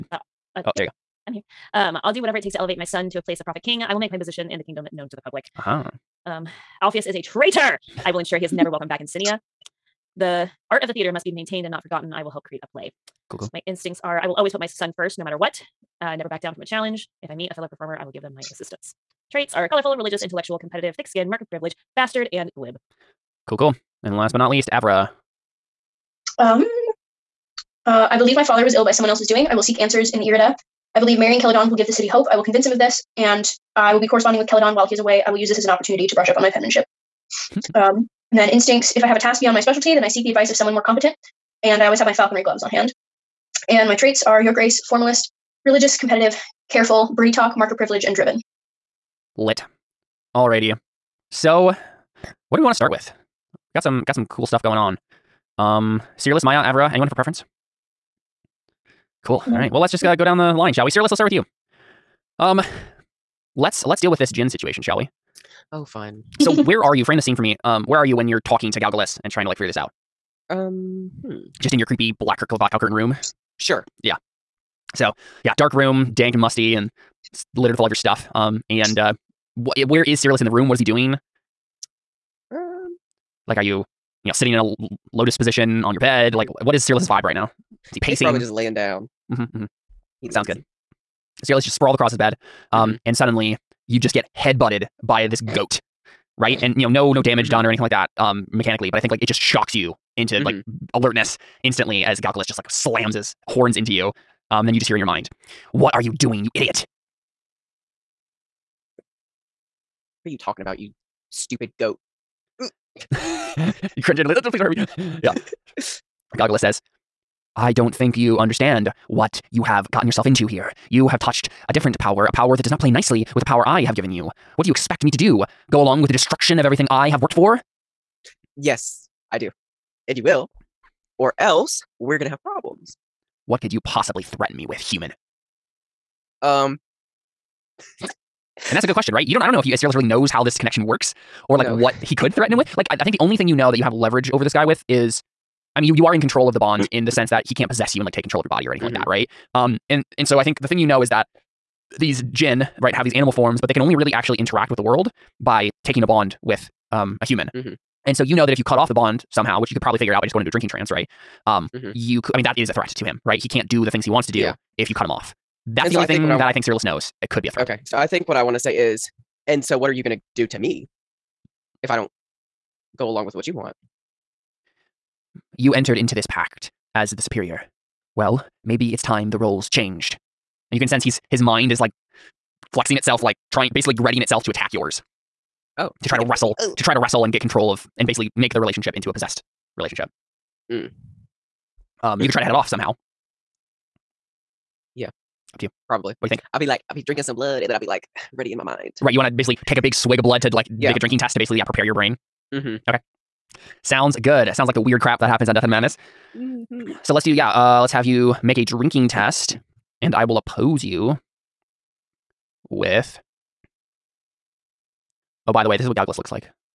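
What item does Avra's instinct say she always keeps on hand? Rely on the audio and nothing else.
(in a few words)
falconry gloves.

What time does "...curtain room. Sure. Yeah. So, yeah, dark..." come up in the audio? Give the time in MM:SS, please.
01:12.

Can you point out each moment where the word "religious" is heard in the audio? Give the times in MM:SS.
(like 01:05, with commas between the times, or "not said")
00:19, 00:45.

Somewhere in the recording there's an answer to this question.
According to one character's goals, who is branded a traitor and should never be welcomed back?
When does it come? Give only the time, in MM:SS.
00:06.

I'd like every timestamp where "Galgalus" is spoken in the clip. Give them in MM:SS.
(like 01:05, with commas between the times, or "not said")
01:08, 01:42, 03:35.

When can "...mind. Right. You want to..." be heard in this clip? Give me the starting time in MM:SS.
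03:18.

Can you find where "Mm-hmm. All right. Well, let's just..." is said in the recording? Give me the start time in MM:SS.
00:59.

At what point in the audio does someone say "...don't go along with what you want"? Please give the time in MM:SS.
02:51.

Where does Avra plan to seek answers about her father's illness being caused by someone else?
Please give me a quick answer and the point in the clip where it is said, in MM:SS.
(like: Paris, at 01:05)
the Irida, at 00:30.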